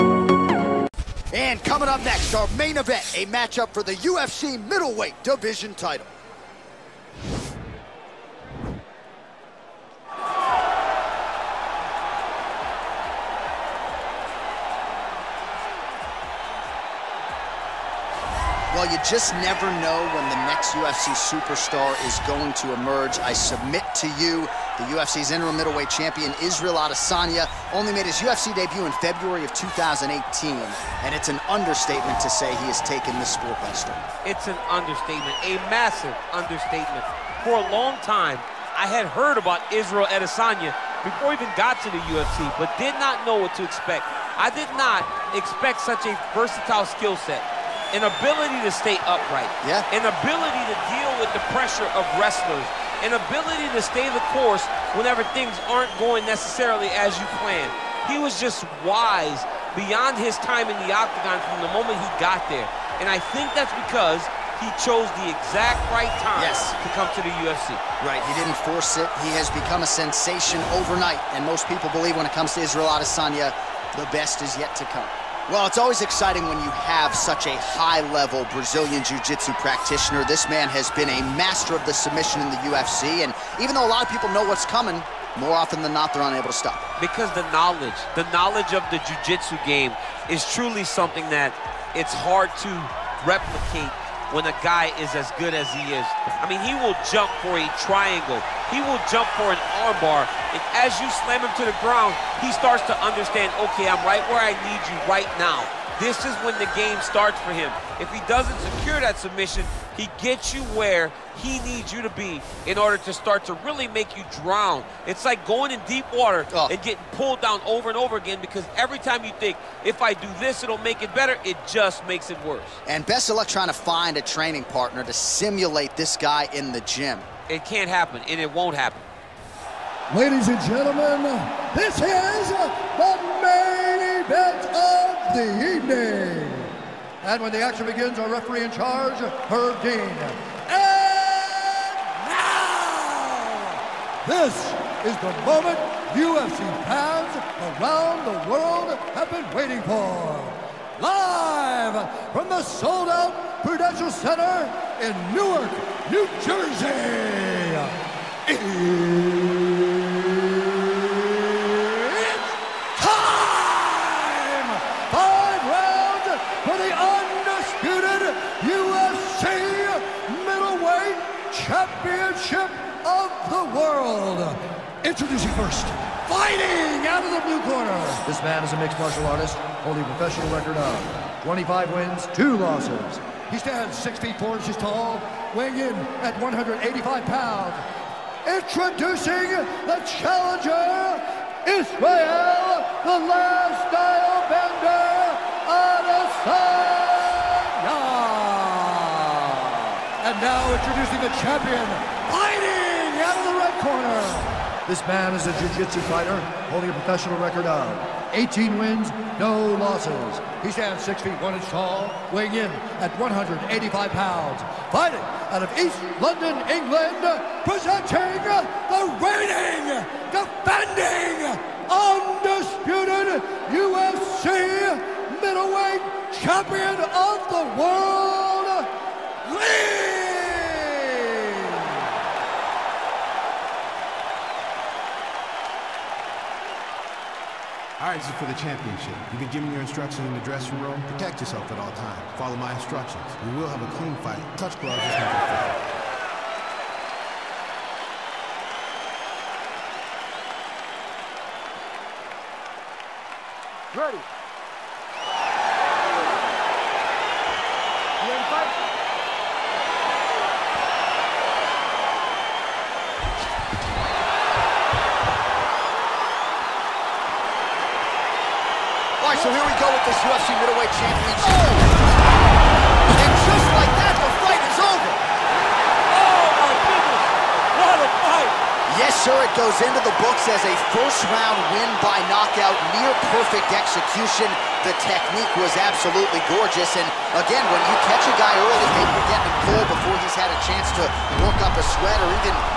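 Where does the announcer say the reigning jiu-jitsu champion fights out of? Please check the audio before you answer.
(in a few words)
East London, England.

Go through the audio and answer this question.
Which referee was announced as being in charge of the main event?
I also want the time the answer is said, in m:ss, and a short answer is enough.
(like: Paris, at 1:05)
Herb Dean, at 2:19.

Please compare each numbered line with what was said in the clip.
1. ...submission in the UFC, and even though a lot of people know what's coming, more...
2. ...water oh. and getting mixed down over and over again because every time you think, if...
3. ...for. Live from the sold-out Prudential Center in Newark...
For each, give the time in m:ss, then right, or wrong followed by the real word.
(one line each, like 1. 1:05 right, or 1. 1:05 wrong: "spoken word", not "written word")
1. 1:21 right
2. 1:56 wrong: "pulled", not "mixed"
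3. 2:29 right.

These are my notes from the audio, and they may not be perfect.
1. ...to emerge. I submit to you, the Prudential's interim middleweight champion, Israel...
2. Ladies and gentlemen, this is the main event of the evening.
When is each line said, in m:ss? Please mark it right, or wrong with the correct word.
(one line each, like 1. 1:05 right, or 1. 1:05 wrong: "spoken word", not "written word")
1. 0:22 wrong: "UFC", not "Prudential"
2. 2:10 right.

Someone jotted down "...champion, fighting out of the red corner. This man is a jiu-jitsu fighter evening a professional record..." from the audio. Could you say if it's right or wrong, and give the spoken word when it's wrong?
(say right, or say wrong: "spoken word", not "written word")
wrong: "holding", not "evening".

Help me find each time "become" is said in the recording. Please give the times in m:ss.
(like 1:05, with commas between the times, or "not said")
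1:09.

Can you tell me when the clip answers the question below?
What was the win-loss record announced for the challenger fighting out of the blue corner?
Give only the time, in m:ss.
3:01.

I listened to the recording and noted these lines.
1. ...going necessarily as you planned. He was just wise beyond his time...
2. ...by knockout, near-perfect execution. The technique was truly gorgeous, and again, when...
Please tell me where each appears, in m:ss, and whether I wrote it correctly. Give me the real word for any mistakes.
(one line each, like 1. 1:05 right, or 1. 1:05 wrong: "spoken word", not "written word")
1. 0:56 right
2. 4:42 wrong: "absolutely", not "truly".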